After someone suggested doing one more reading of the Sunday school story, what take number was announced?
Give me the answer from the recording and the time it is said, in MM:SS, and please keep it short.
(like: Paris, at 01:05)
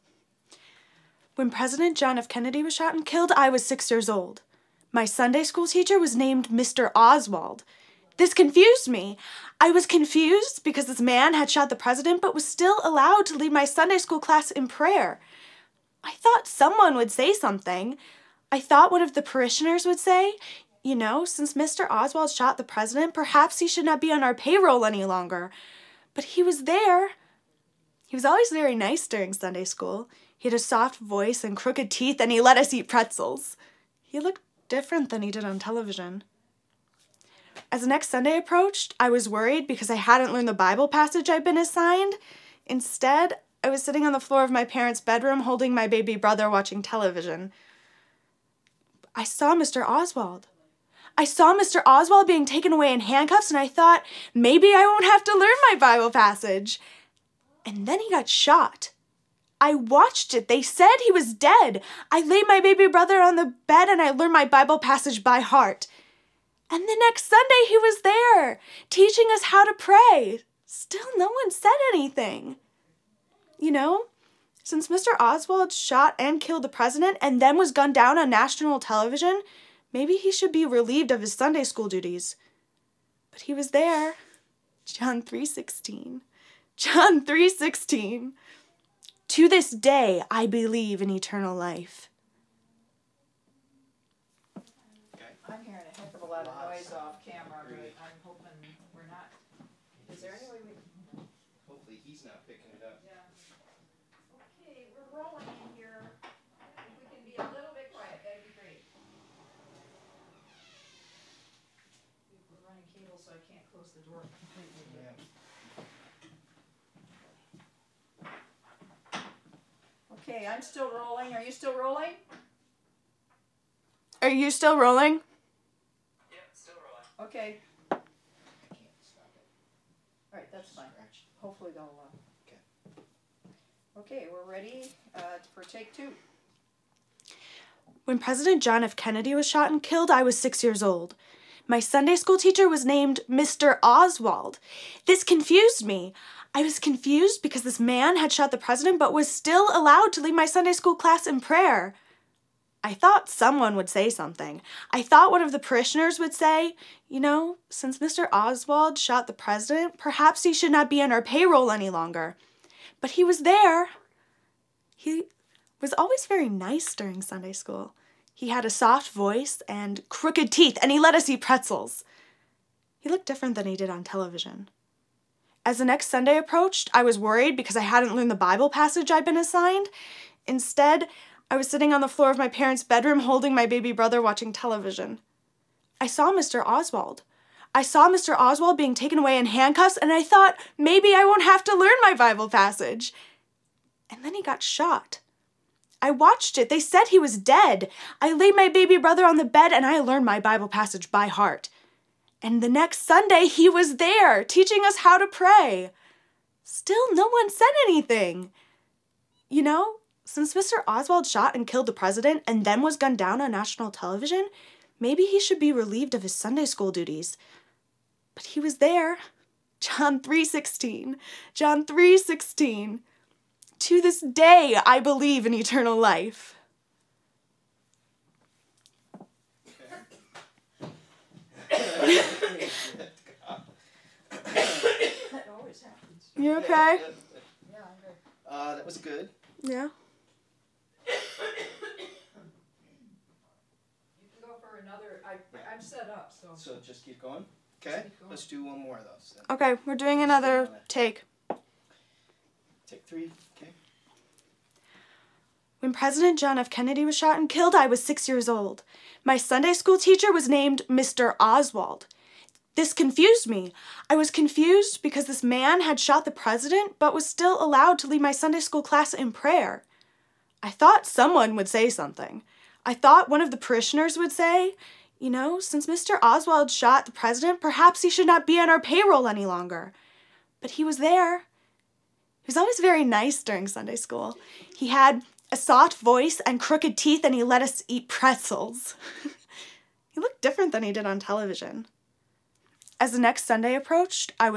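Take three, at 04:12.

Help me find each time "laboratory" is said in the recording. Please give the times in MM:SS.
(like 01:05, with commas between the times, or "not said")
not said.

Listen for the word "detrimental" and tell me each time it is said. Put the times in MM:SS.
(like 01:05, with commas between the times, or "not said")
not said.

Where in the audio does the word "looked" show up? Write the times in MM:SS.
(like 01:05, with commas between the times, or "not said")
00:34, 02:53, 04:50.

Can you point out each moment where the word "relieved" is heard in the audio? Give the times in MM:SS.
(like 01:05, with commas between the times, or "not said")
01:20, 03:35.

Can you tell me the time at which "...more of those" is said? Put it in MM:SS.
04:08.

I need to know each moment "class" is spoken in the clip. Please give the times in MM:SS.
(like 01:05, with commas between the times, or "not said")
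00:14, 02:30, 04:28.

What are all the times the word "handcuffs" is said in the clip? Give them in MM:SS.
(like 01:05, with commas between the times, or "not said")
00:52, 03:09.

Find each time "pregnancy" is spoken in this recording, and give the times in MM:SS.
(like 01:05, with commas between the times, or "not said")
not said.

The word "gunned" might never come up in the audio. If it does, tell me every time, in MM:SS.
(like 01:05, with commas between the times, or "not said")
01:17, 03:32.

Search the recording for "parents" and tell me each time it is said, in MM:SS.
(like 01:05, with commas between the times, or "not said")
00:44, 03:02.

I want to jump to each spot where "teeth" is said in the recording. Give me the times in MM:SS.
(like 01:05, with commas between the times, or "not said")
00:31, 02:50, 04:46.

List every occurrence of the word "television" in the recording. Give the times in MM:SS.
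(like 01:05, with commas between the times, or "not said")
00:35, 00:46, 01:18, 02:54, 03:04, 03:33, 04:51.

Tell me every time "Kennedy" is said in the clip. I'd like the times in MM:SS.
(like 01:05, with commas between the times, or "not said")
00:02, 02:18, 04:16.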